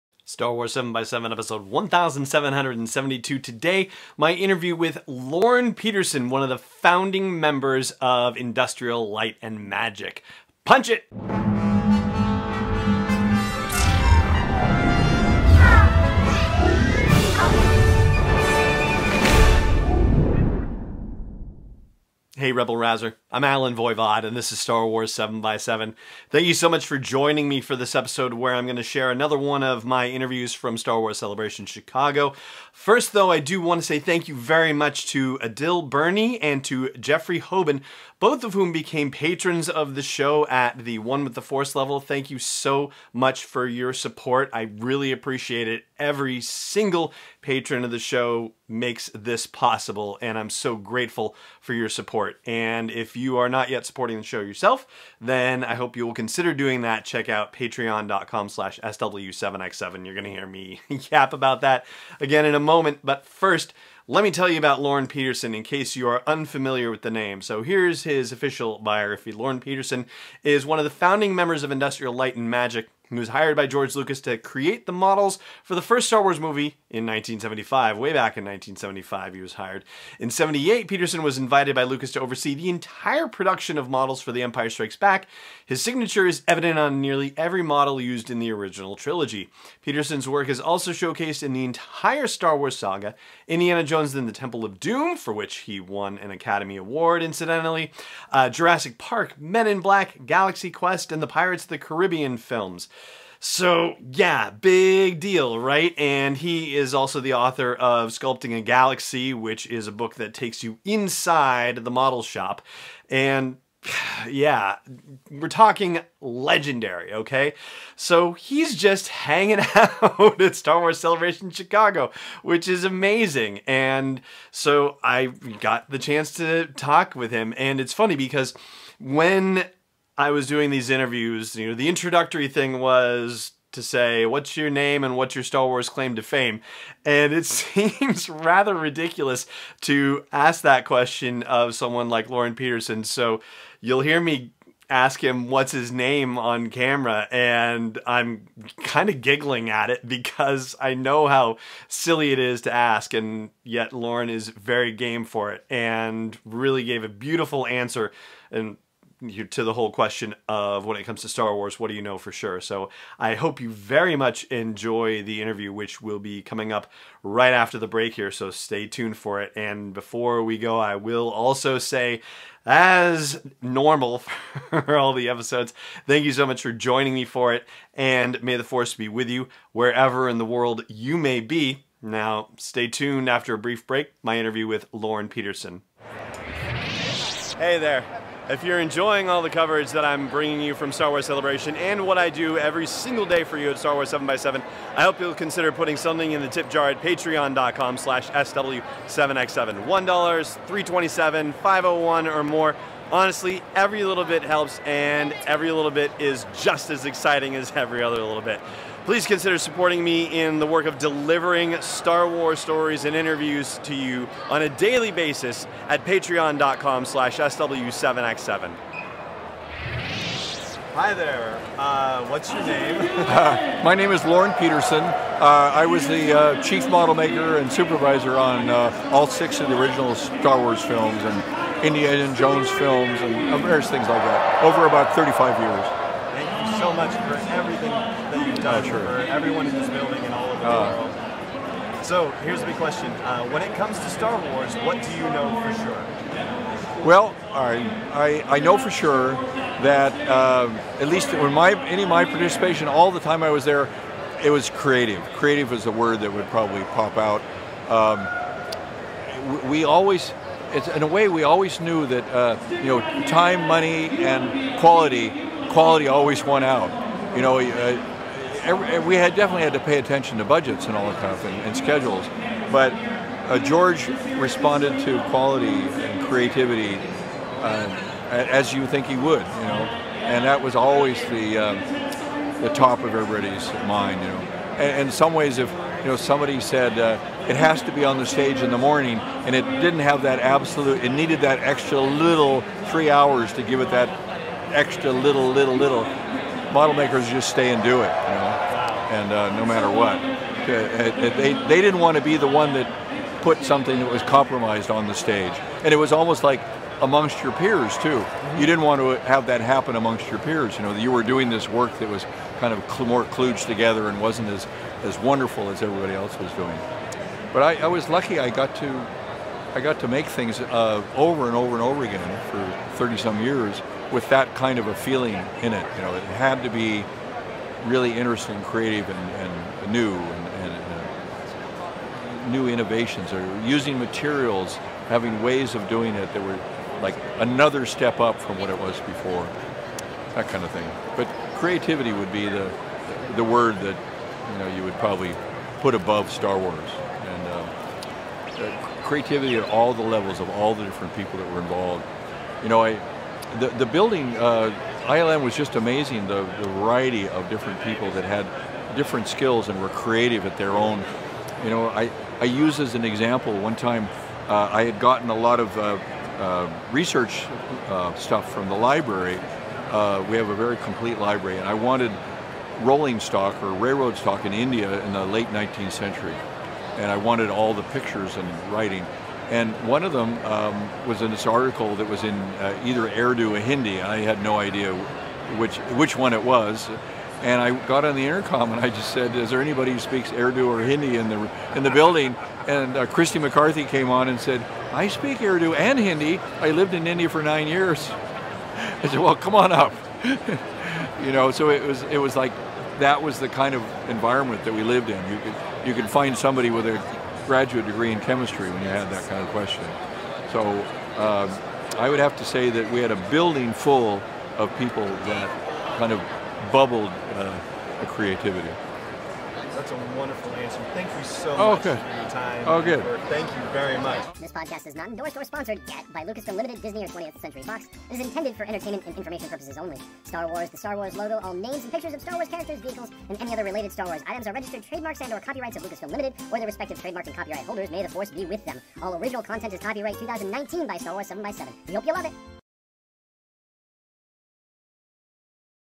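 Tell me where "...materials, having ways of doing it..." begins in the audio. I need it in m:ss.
5:33.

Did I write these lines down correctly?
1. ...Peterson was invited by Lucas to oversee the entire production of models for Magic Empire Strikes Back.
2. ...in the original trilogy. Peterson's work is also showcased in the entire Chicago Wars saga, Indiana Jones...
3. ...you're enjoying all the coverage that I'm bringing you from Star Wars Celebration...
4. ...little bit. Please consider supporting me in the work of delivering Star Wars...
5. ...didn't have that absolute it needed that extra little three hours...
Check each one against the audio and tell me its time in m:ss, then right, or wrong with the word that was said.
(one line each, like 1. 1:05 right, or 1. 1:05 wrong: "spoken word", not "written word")
1. 1:20 wrong: "The", not "Magic"
2. 1:28 wrong: "Star", not "Chicago"
3. 3:08 right
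4. 3:28 right
5. 4:49 right.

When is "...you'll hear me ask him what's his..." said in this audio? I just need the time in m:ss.
2:23.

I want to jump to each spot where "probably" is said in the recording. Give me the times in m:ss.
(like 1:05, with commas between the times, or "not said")
4:16, 5:44.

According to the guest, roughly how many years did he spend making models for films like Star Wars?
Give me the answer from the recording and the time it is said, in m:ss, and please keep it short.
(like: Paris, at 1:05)
35, at 3:55.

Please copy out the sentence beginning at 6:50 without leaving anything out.
So um, I would have to say that we had a building full of people that kind of bubbled uh, creativity.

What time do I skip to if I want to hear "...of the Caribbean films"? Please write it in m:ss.
1:41.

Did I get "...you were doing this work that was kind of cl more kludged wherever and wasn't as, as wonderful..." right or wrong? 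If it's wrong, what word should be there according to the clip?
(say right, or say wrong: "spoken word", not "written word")
wrong: "together", not "wherever".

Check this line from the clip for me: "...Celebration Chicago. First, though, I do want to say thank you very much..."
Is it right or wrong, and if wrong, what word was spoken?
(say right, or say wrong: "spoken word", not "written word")
right.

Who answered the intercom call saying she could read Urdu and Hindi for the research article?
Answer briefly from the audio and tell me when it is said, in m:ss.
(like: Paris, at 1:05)
Christy McCarthy, at 6:33.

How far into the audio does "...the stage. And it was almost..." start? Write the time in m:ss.
5:05.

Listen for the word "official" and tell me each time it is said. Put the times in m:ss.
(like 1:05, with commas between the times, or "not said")
1:08.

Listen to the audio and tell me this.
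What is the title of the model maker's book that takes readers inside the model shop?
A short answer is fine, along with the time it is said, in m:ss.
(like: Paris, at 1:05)
Sculpting a Galaxy, at 1:48.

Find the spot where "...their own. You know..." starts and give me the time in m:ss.
6:00.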